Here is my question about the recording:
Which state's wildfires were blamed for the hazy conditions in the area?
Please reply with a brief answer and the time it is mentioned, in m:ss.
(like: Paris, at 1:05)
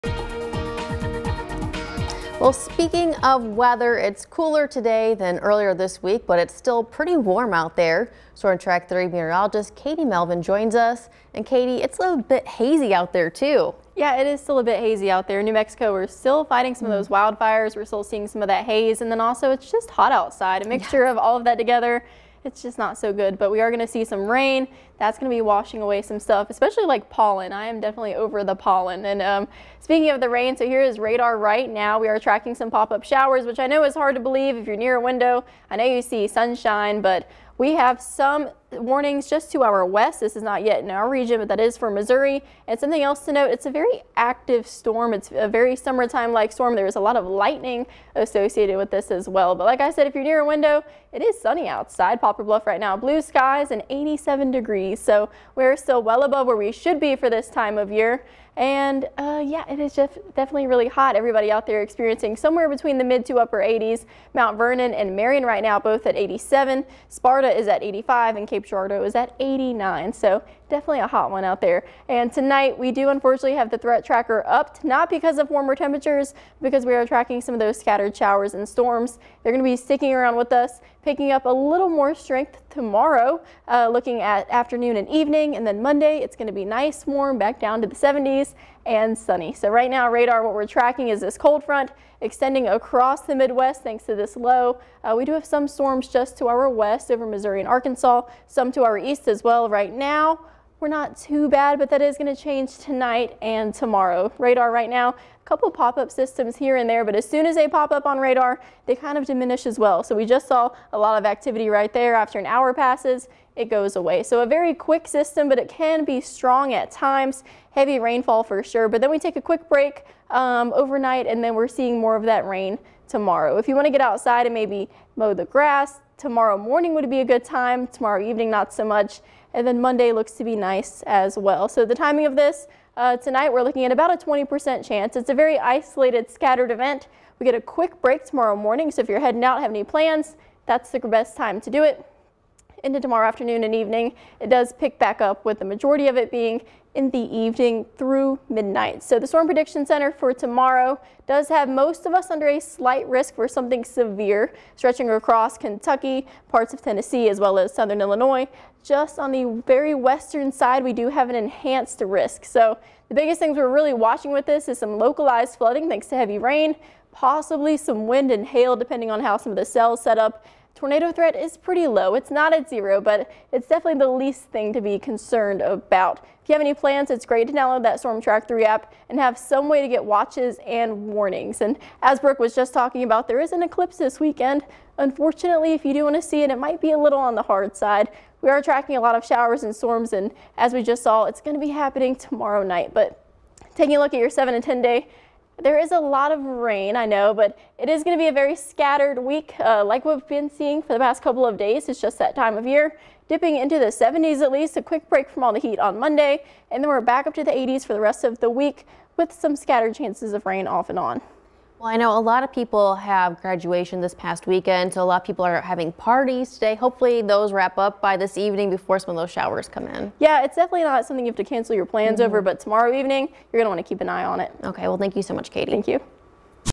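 New Mexico, at 0:15.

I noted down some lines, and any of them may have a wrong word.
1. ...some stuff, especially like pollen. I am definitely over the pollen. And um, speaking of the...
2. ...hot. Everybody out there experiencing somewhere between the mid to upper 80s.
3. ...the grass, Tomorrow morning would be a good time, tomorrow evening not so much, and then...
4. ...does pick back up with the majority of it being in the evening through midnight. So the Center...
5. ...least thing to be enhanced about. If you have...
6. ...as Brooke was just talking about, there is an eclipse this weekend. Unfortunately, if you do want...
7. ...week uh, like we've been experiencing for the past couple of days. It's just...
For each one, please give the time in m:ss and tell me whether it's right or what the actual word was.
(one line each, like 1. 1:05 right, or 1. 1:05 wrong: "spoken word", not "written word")
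1. 0:26 right
2. 1:00 right
3. 2:05 right
4. 2:24 wrong: "Storm", not "Center"
5. 2:54 wrong: "concerned", not "enhanced"
6. 3:02 right
7. 3:19 wrong: "seeing", not "experiencing".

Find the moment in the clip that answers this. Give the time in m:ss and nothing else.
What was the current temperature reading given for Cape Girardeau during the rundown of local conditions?
1:09.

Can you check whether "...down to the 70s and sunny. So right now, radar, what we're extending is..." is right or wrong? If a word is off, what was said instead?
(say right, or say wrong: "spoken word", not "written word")
wrong: "tracking", not "extending".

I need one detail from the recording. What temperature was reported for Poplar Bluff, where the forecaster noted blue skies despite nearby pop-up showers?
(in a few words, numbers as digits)
87 degrees.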